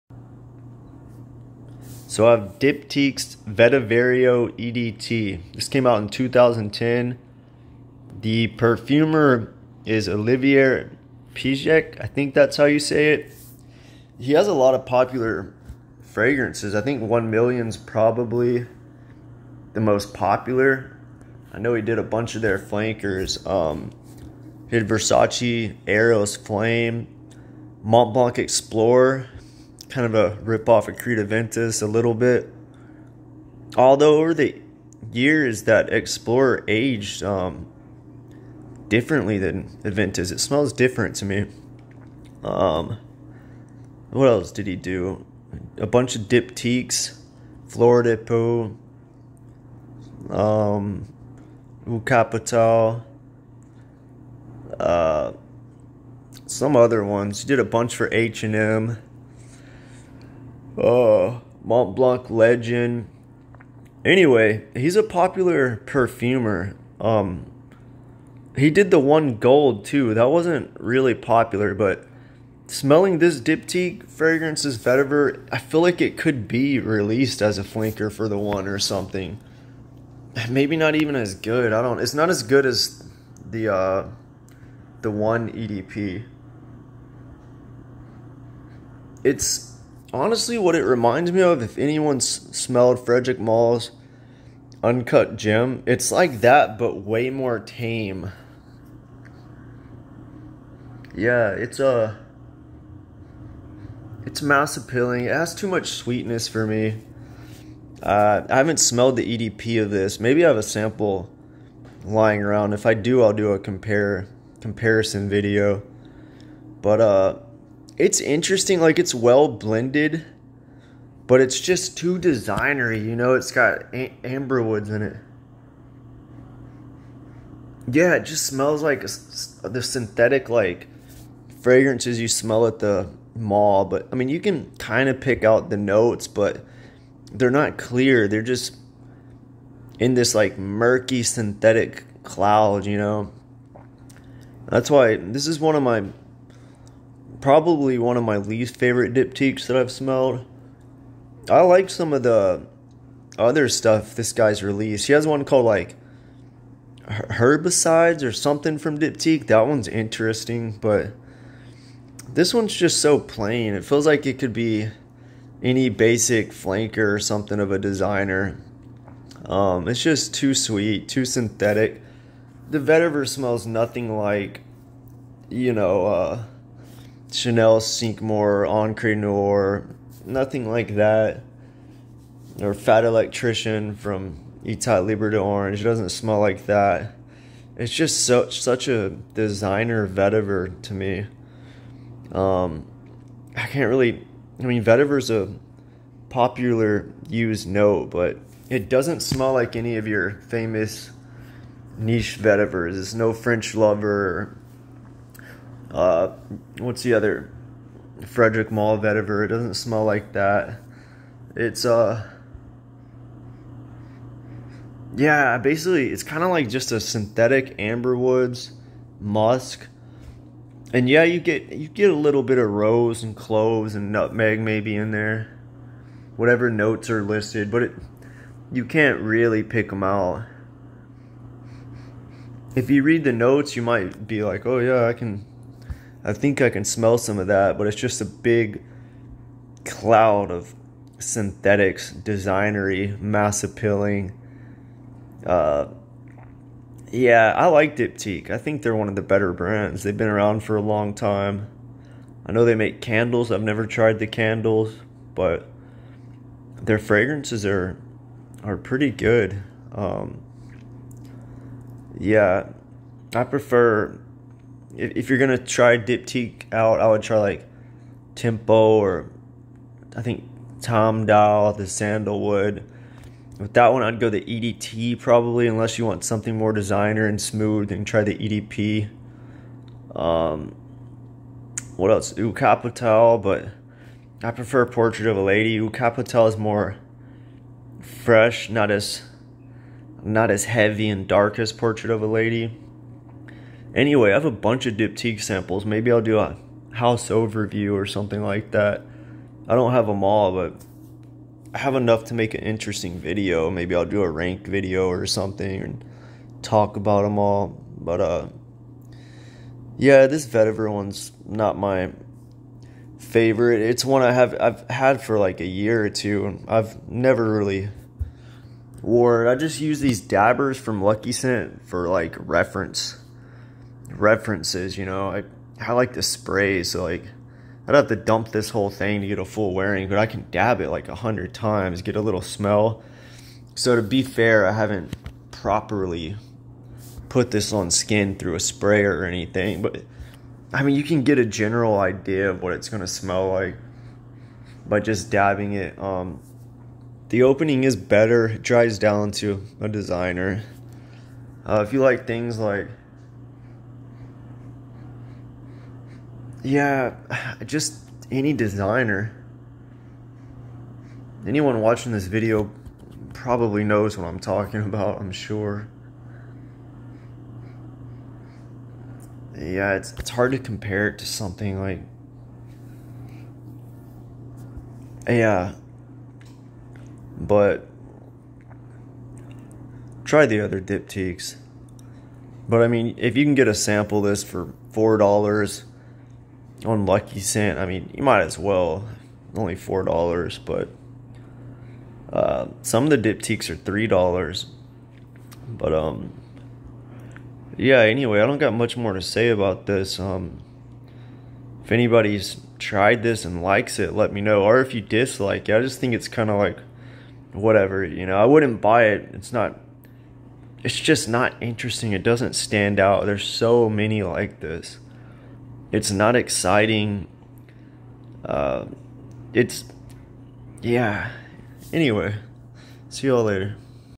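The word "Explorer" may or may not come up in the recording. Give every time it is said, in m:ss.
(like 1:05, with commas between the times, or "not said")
0:28, 0:35.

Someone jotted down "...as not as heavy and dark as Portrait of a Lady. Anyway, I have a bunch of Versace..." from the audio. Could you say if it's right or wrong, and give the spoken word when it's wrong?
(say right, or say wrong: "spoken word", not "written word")
wrong: "Diptyque", not "Versace".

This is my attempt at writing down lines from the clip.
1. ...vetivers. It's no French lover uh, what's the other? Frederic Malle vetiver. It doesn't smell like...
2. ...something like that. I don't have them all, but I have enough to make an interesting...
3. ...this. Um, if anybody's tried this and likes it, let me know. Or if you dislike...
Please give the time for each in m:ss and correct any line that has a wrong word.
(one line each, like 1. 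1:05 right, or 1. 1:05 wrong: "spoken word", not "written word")
1. 3:22 right
2. 4:58 right
3. 6:39 right.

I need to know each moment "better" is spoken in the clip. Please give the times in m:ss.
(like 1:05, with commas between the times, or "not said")
4:09, 5:47.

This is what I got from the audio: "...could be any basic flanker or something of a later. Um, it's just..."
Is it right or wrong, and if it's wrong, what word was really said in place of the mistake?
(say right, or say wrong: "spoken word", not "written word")
wrong: "designer", not "later".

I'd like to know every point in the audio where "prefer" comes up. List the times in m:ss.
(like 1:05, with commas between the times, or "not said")
4:23, 4:44.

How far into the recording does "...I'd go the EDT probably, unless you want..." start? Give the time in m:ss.
4:34.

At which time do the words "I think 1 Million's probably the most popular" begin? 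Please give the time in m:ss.
0:16.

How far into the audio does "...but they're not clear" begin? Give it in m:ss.
2:16.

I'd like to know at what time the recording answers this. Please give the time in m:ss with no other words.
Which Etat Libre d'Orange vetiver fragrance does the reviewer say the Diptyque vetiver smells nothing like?
3:02.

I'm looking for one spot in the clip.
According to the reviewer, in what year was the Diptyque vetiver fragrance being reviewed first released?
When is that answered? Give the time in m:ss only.
0:06.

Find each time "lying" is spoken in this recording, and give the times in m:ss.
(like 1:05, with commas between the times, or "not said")
1:52.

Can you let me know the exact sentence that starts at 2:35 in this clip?
He has one called like herbicides or something from Diptyque.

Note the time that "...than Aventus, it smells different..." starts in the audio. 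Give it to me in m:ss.
0:39.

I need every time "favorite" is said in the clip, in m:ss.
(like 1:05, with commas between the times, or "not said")
2:28, 5:13.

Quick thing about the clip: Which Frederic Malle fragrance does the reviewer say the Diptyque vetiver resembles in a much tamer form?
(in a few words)
Uncut Gem.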